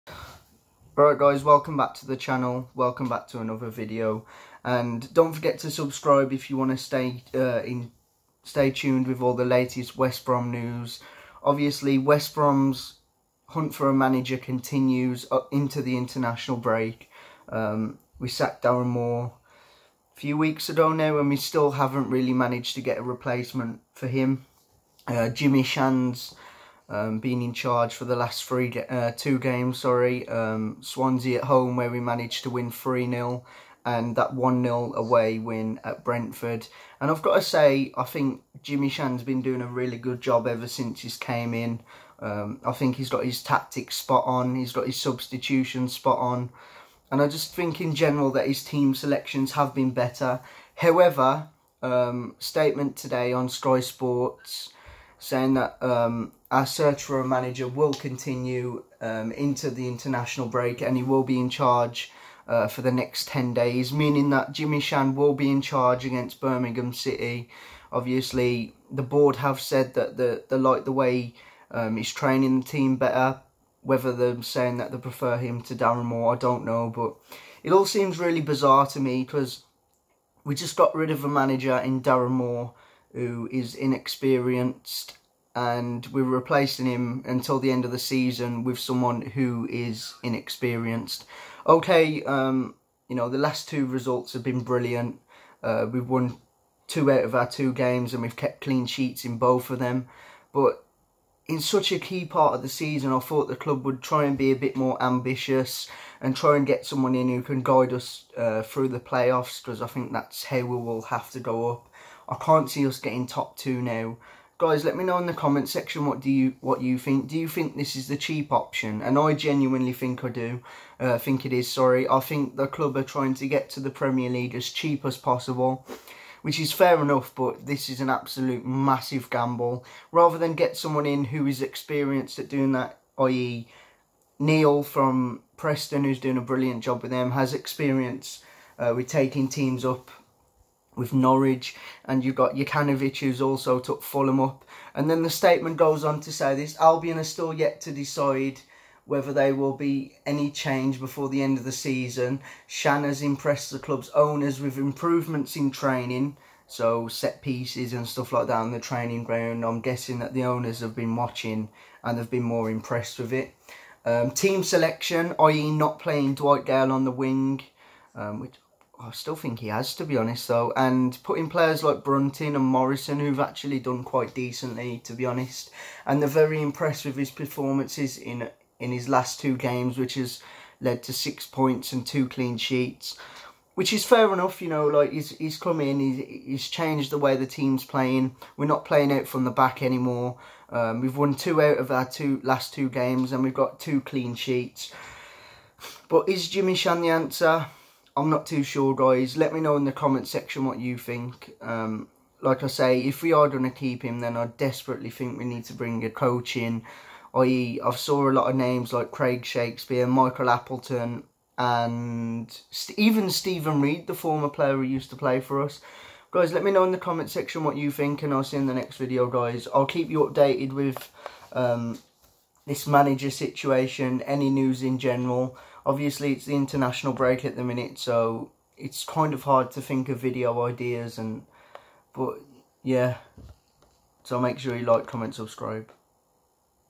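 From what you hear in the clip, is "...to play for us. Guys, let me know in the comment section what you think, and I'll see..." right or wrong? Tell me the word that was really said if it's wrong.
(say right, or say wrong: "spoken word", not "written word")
right.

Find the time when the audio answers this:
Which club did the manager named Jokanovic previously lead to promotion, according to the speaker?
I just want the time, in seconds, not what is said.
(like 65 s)
144 s.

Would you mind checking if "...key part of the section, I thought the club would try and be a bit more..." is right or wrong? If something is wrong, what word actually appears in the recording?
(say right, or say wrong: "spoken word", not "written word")
wrong: "season", not "section".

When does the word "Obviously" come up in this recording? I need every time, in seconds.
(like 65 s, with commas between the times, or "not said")
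11 s, 67 s, 225 s.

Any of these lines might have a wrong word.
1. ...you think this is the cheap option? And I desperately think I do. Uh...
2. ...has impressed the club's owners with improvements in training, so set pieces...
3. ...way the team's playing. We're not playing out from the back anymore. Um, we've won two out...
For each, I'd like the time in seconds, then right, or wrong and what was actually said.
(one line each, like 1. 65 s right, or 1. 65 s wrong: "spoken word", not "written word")
1. 117 s wrong: "genuinely", not "desperately"
2. 153 s right
3. 187 s right.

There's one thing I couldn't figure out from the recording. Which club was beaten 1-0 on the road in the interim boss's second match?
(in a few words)
Brentford.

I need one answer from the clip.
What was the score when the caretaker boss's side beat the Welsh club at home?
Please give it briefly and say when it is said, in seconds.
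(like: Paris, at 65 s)
3-0, at 32 s.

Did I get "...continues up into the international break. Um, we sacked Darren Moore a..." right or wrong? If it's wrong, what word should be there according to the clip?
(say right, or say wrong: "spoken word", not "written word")
right.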